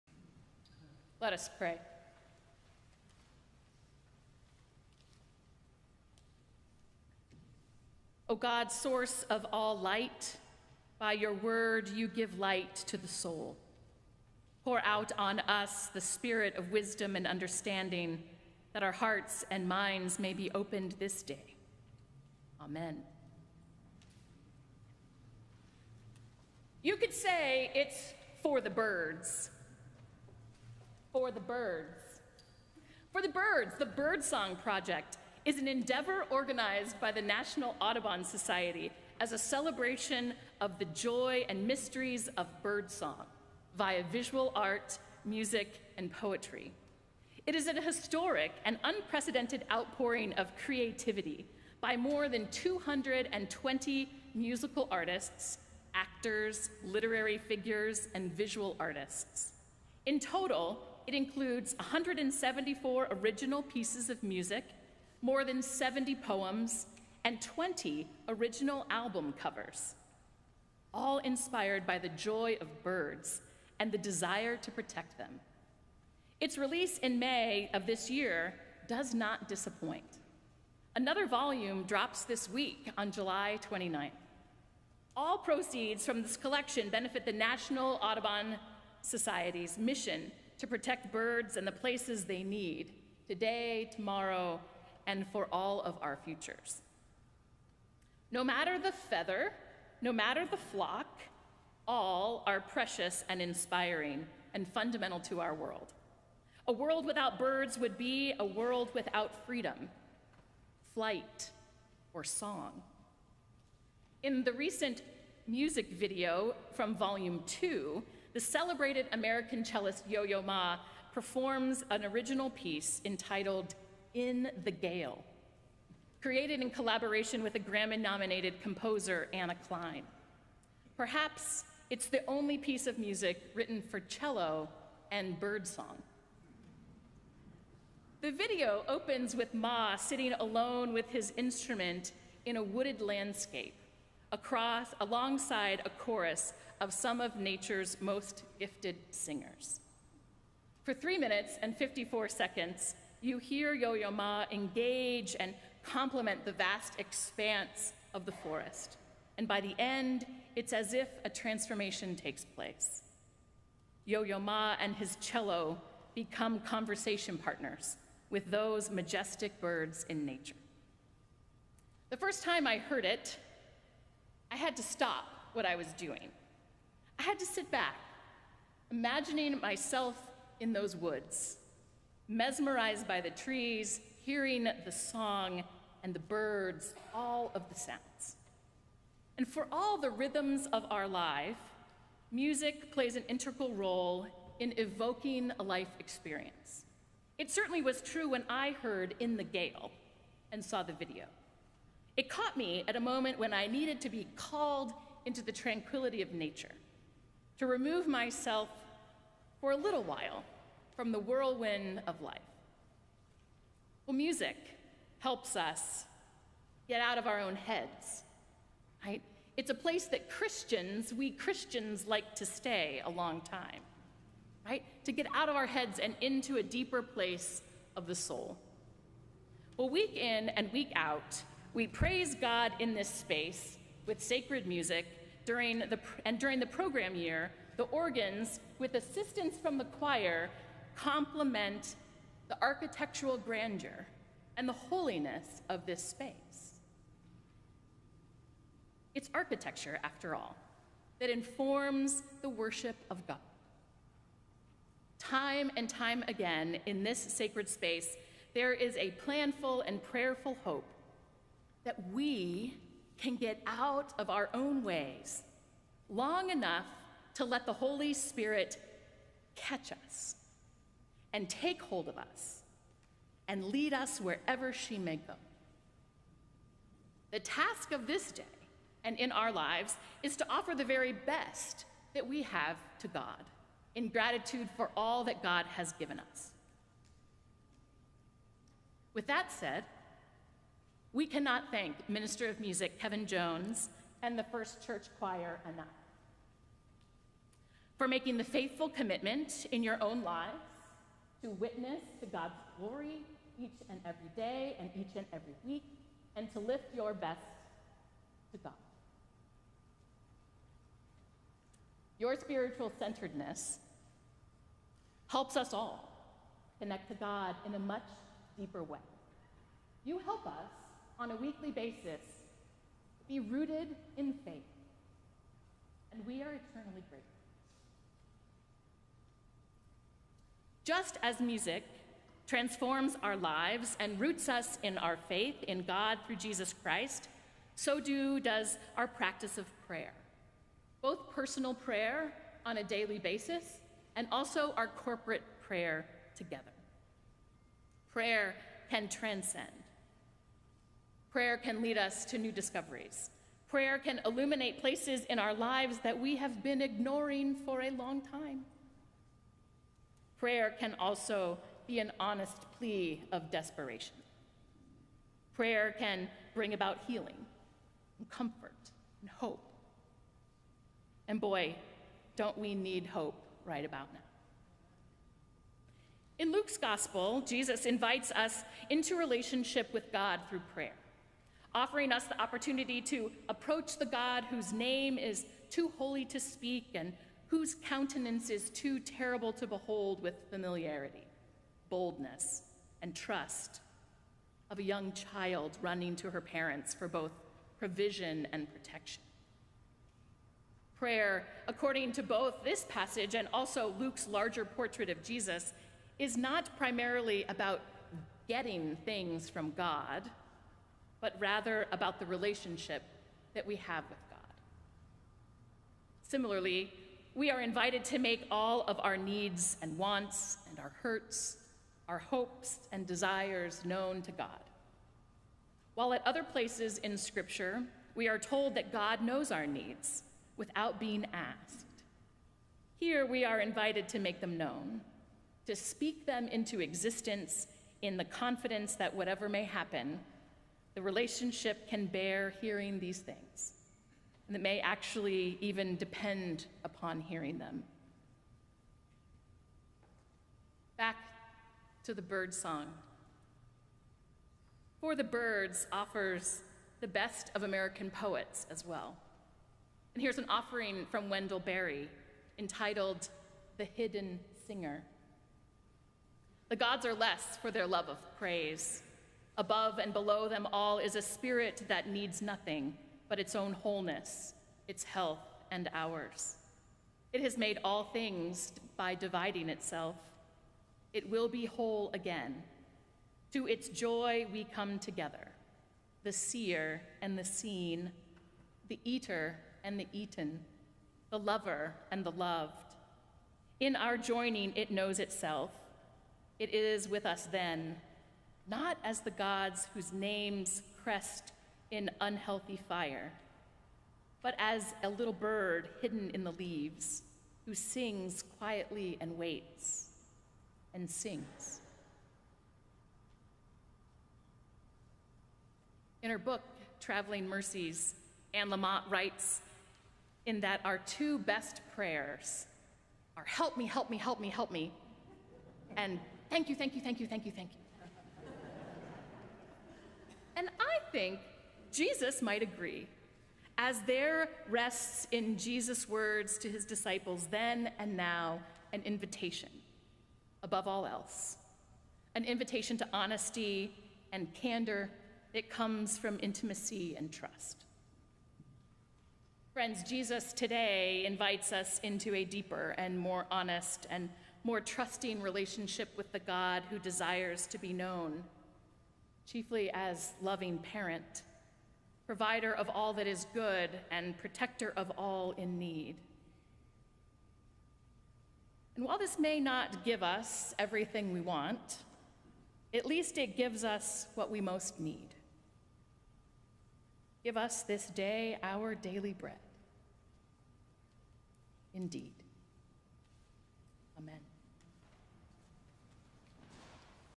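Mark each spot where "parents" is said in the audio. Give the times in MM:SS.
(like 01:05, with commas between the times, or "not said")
06:36, 09:20.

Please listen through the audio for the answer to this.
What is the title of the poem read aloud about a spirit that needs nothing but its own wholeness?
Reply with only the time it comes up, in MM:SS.
07:43.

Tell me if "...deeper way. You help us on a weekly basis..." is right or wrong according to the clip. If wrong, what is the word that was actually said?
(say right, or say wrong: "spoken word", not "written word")
right.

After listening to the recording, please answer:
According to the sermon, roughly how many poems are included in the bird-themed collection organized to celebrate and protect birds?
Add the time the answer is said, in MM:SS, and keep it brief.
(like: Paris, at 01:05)
more than 70, at 01:05.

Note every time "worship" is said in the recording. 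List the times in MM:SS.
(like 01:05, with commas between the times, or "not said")
04:12.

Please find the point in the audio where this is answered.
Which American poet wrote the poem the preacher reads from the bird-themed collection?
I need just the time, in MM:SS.
07:41.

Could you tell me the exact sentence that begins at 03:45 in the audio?
To get out of our heads and into a deeper place of the soul.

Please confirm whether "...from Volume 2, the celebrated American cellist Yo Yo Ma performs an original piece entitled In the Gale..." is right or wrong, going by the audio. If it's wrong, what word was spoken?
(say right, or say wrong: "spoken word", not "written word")
right.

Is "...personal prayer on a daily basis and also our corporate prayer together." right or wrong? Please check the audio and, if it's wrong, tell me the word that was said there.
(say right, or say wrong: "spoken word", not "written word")
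right.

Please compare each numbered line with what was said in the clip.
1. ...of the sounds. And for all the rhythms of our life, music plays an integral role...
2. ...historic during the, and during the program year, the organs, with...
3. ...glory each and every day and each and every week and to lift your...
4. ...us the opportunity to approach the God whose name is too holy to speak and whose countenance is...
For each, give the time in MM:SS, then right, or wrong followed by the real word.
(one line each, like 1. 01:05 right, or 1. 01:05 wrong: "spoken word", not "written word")
1. 03:07 right
2. 03:54 wrong: "music", not "historic"
3. 05:02 right
4. 06:22 right.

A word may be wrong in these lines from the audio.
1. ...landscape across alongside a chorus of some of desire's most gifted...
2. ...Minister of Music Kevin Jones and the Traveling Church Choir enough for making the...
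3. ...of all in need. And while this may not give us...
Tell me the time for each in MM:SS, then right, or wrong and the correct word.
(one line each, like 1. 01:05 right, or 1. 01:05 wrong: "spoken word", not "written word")
1. 02:23 wrong: "nature", not "desire"
2. 04:52 wrong: "First", not "Traveling"
3. 09:24 right.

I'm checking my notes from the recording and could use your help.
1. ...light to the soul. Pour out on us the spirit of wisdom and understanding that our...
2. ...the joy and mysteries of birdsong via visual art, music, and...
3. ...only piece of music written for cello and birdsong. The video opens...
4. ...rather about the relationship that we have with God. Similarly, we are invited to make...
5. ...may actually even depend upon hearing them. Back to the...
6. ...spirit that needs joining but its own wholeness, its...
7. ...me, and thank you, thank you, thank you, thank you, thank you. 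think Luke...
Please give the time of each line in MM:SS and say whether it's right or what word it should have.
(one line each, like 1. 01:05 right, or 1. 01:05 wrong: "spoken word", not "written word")
1. 00:12 right
2. 00:40 right
3. 02:12 right
4. 06:51 right
5. 07:24 right
6. 07:51 wrong: "nothing", not "joining"
7. 08:44 wrong: "Jesus", not "Luke".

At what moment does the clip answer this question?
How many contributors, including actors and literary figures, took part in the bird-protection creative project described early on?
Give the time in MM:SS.
00:52.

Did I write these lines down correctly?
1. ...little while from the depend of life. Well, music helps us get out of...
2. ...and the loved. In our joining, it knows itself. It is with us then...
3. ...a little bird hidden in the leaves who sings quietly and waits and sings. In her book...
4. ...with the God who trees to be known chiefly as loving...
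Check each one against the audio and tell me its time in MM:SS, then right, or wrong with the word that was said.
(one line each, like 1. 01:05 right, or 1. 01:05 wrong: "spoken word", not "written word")
1. 03:29 wrong: "whirlwind", not "depend"
2. 08:12 right
3. 08:25 right
4. 09:16 wrong: "desires", not "trees".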